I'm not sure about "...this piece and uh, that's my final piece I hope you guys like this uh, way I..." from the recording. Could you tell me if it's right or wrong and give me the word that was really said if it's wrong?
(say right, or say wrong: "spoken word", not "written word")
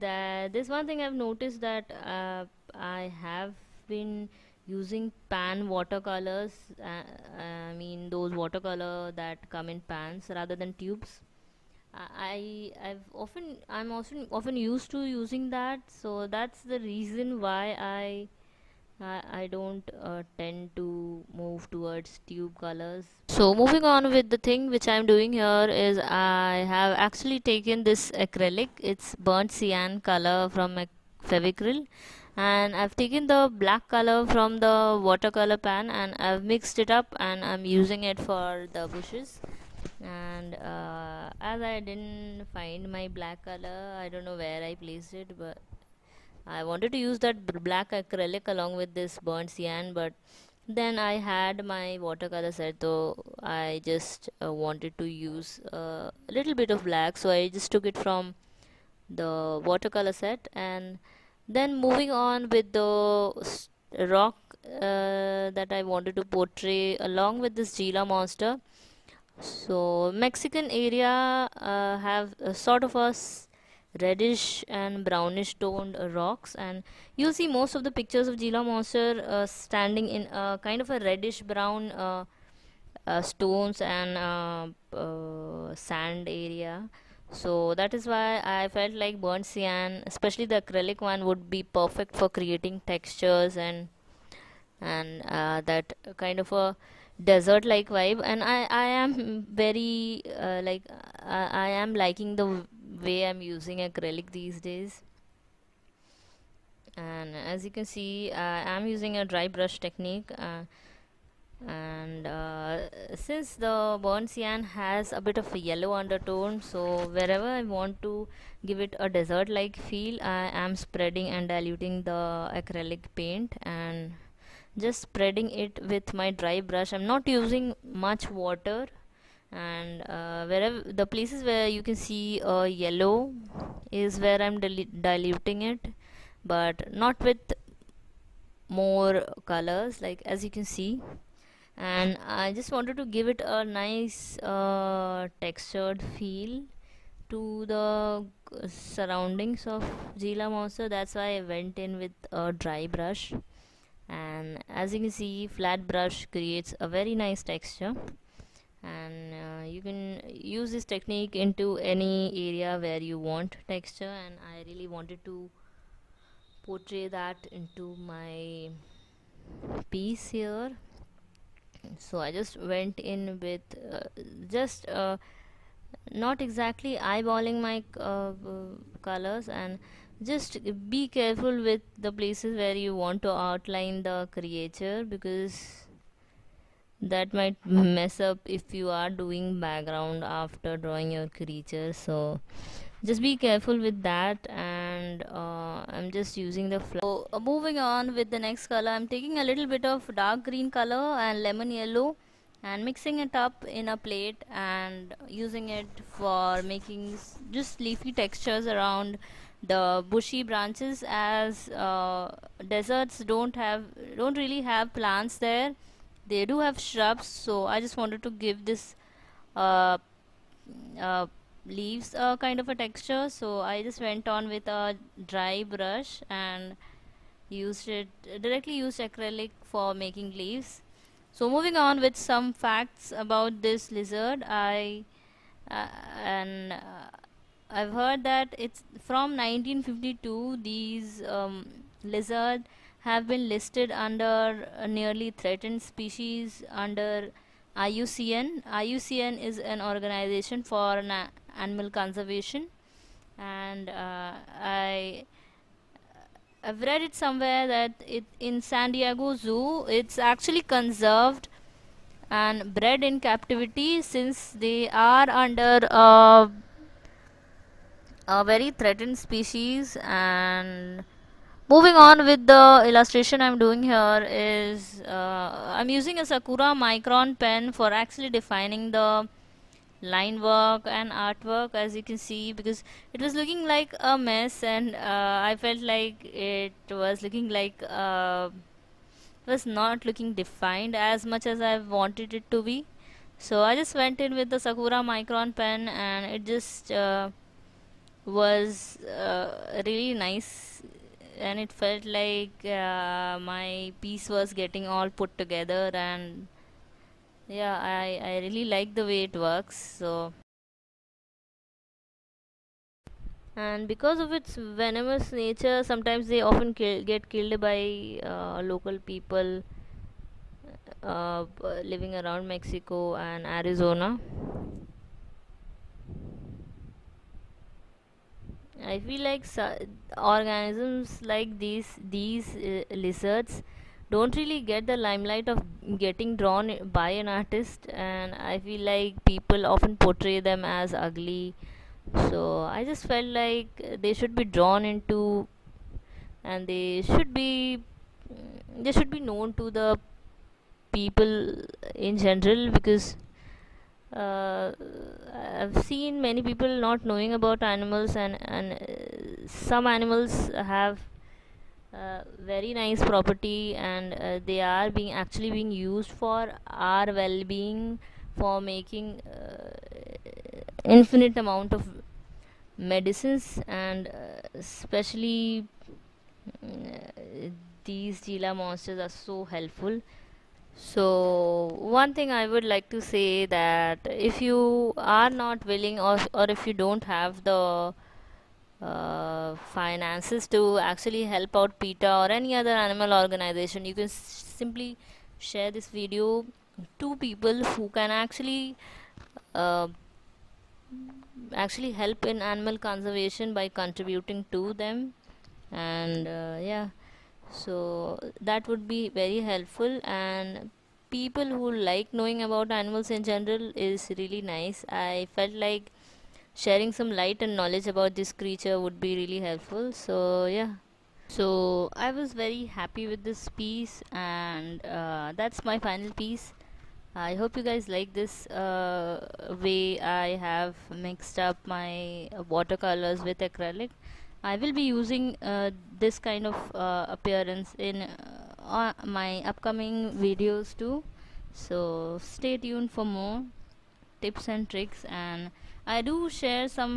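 right.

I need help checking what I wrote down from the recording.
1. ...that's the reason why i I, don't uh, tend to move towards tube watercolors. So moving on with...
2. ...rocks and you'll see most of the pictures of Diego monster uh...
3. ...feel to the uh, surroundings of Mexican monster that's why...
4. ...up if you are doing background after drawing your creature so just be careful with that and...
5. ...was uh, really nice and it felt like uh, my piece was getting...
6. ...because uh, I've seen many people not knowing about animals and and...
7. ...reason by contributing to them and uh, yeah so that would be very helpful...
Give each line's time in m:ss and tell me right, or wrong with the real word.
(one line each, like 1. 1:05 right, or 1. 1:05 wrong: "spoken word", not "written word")
1. 0:16 wrong: "colors", not "watercolors"
2. 1:16 wrong: "Gila", not "Diego"
3. 2:26 wrong: "Gila", not "Mexican"
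4. 3:08 right
5. 4:58 right
6. 5:52 right
7. 6:42 wrong: "conservation", not "reason".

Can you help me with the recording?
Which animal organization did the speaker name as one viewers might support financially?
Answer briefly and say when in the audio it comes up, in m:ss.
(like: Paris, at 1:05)
PETA, at 6:31.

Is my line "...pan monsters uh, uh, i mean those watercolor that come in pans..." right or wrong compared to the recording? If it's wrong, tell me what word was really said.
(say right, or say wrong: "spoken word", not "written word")
wrong: "watercolors", not "monsters".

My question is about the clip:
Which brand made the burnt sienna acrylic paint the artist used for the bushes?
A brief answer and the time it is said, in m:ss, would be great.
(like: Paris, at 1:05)
Fevicryl, at 0:31.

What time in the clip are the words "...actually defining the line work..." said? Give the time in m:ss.
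4:37.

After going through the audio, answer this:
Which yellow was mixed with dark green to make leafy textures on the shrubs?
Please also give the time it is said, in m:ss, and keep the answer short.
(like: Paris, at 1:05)
Lemon yellow, at 3:21.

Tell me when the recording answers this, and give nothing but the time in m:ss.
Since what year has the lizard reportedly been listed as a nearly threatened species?
3:59.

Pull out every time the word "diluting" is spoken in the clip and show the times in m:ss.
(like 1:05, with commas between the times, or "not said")
2:01, 2:14.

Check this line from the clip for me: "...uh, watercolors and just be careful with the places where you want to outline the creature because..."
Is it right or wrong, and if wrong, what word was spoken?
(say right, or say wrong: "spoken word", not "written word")
wrong: "colors", not "watercolors".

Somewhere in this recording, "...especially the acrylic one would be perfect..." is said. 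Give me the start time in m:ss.
1:30.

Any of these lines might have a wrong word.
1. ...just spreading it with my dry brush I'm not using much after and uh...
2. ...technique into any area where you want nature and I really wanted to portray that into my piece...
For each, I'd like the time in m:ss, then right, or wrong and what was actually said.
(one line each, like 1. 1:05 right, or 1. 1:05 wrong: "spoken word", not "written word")
1. 2:04 wrong: "water", not "after"
2. 2:40 wrong: "texture", not "nature".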